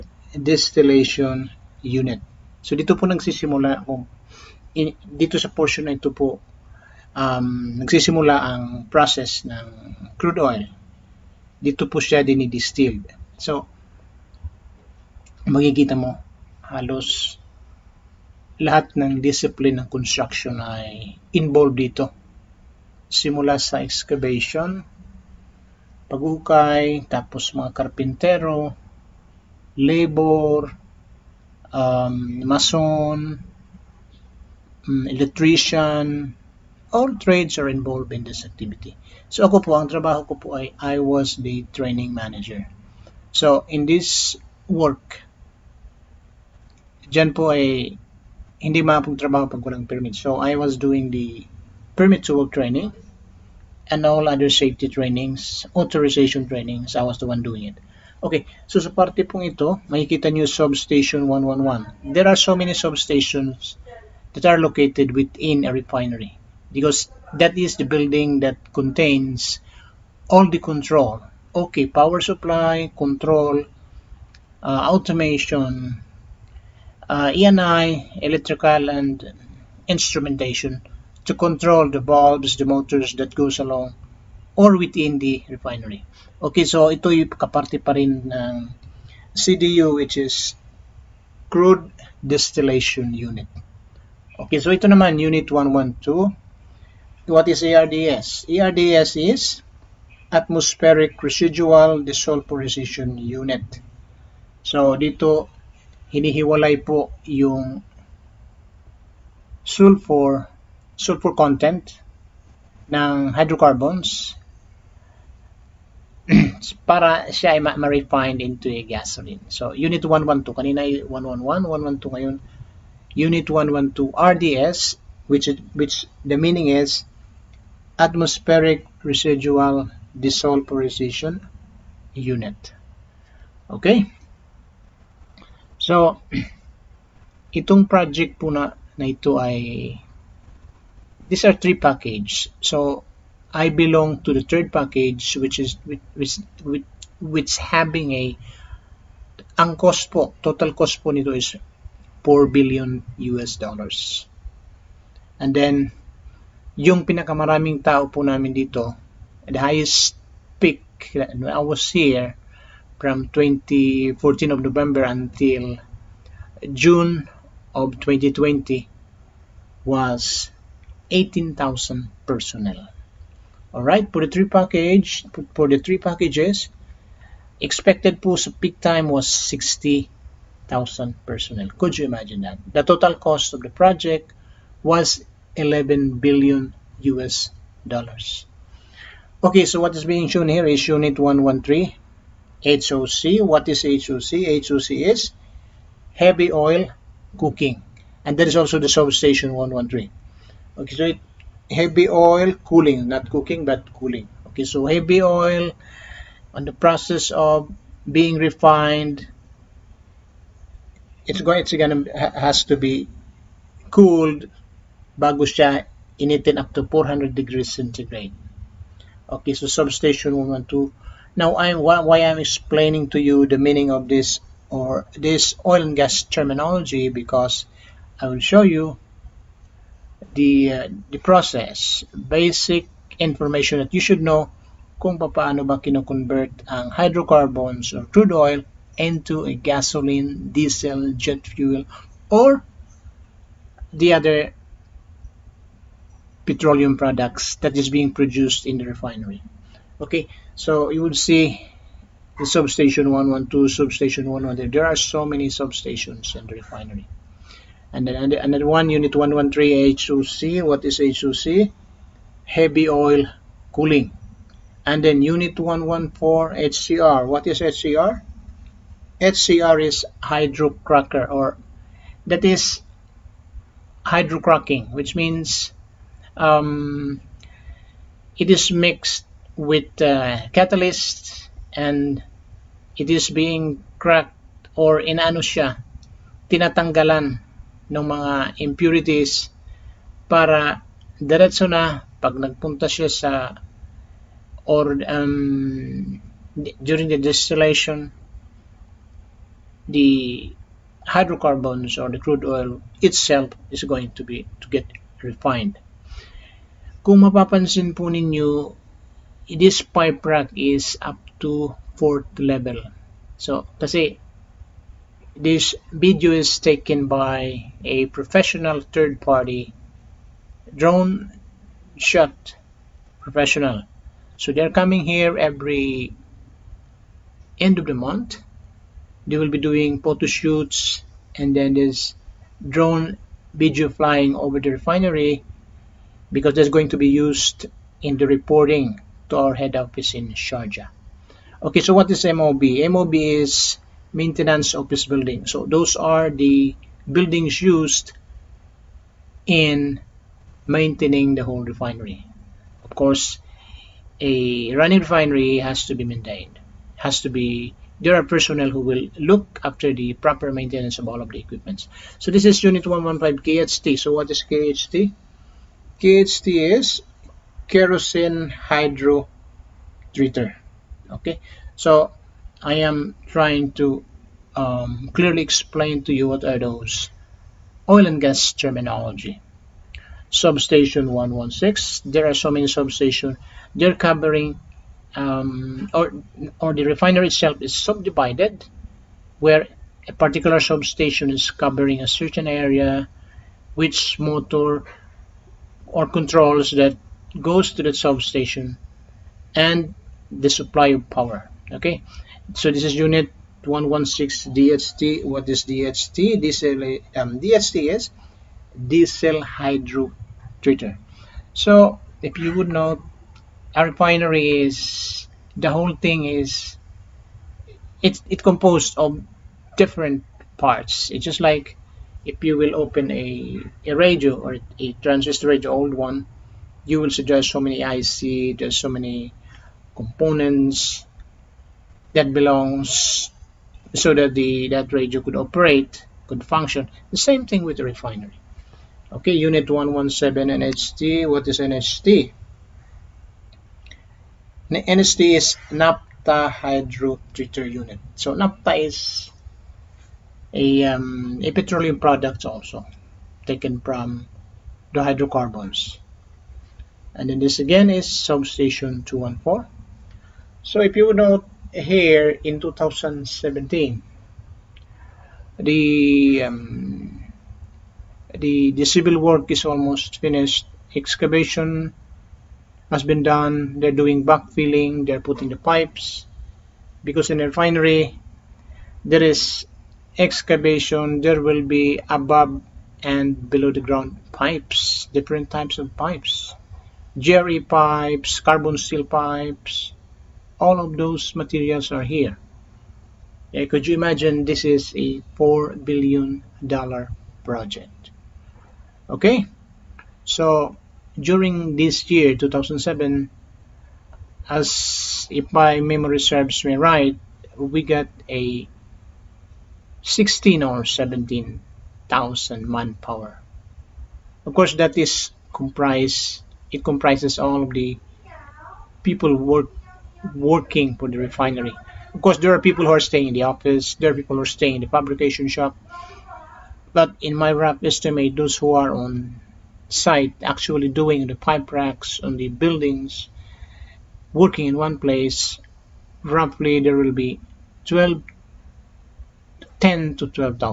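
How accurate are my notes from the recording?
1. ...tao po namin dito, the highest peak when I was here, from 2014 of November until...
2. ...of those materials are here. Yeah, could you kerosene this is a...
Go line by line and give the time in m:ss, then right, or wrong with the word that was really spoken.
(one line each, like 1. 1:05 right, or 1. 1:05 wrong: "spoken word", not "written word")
1. 2:37 right
2. 8:10 wrong: "imagine", not "kerosene".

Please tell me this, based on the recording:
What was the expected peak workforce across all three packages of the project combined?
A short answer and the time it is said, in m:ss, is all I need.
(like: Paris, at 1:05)
60,000, at 2:59.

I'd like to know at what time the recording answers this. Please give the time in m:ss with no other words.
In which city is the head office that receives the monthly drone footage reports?
5:40.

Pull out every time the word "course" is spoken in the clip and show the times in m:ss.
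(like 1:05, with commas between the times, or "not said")
5:52, 8:34, 8:42.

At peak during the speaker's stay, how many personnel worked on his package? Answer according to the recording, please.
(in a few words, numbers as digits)
18,000.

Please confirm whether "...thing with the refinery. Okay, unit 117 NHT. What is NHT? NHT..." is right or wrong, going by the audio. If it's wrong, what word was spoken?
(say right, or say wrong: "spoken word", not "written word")
right.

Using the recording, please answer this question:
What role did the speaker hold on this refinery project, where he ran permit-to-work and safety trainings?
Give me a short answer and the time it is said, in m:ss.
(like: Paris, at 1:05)
training manager, at 0:41.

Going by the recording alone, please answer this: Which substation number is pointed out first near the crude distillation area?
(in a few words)
111.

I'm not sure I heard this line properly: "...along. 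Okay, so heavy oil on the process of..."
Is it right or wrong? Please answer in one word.
wrong.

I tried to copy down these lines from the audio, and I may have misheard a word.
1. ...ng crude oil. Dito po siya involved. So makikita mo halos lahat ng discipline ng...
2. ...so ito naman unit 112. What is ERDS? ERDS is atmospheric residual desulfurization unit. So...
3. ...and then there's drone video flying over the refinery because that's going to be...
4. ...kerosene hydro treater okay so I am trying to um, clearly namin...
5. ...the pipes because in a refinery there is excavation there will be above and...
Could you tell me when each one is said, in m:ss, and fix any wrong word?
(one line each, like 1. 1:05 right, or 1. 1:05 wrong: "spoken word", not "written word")
1. 0:09 wrong: "dinidistilled", not "involved"
2. 1:34 right
3. 5:31 right
4. 6:07 wrong: "explain", not "namin"
5. 7:55 right.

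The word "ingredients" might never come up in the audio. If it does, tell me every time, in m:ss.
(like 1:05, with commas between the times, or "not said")
not said.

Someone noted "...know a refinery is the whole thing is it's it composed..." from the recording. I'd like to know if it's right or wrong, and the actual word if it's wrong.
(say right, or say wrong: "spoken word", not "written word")
right.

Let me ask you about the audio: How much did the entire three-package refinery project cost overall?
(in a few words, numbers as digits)
11 billion US dollars.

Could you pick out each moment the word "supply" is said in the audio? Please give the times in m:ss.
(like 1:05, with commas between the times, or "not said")
1:12, 6:40.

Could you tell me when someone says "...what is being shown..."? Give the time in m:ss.
3:09.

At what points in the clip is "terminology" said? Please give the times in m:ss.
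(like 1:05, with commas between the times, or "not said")
3:46, 6:18.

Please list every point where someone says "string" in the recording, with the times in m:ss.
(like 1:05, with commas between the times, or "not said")
not said.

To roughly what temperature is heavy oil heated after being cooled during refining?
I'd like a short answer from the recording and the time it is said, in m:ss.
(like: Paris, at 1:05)
400 degrees centigrade, at 3:36.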